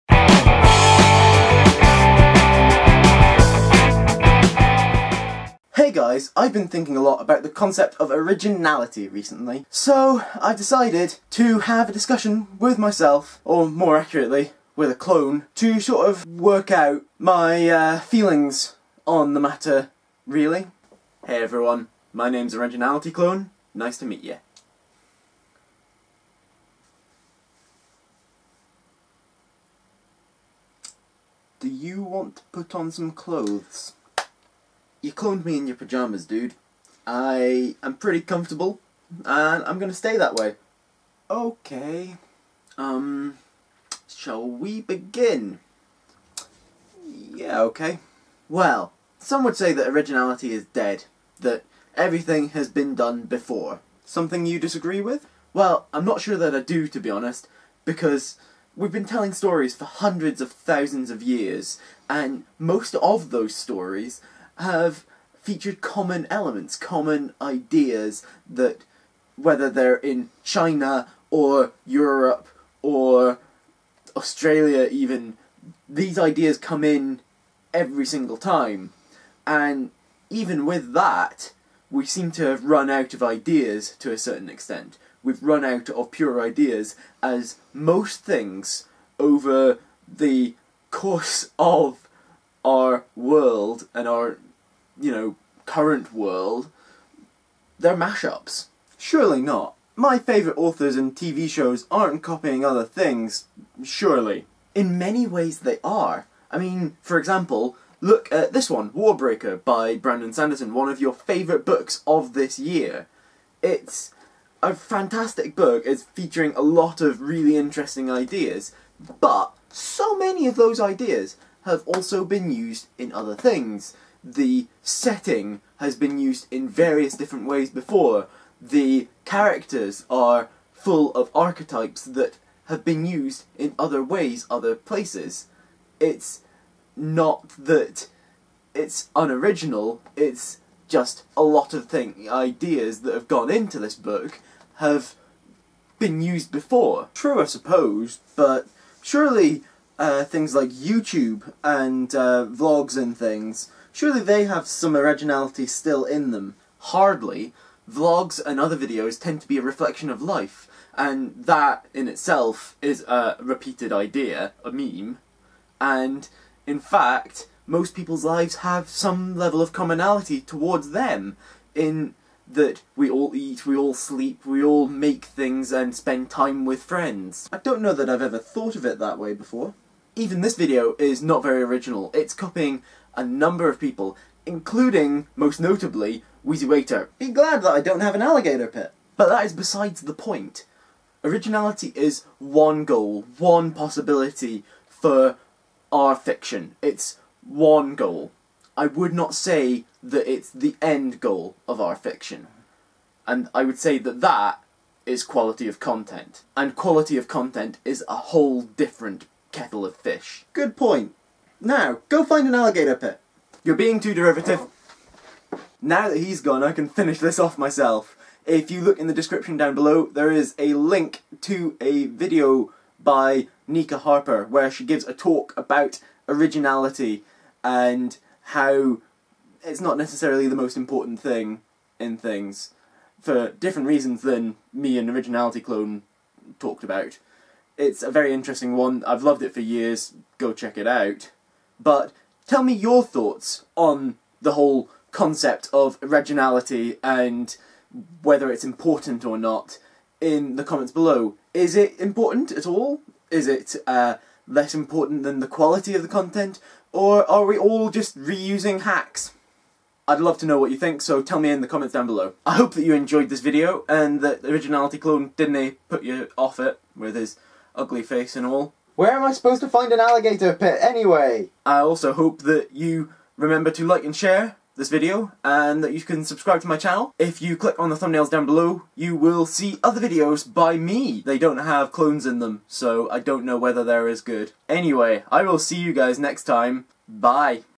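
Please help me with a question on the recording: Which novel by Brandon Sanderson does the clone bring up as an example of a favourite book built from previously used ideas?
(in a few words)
Warbreaker.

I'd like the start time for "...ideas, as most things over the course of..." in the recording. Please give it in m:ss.
1:26.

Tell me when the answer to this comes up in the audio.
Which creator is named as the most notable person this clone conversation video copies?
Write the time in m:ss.
3:06.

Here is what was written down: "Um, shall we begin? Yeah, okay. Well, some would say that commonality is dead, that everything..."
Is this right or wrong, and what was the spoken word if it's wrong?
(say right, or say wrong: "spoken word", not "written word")
wrong: "originality", not "commonality".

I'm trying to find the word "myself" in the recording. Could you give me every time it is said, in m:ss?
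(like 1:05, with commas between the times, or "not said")
0:12, 3:37.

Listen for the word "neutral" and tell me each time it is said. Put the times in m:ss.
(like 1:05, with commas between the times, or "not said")
not said.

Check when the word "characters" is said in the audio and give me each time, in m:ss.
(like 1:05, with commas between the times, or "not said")
2:09.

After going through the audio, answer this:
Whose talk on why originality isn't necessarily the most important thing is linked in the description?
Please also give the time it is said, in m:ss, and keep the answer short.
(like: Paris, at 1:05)
Nika Harper, at 3:43.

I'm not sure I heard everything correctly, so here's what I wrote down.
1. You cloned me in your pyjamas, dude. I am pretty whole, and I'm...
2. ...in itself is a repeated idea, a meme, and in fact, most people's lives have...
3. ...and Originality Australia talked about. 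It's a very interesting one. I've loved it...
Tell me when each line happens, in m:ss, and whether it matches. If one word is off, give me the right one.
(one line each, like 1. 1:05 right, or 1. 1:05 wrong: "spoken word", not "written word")
1. 0:35 wrong: "comfortable", not "whole"
2. 2:41 right
3. 3:54 wrong: "Clone", not "Australia".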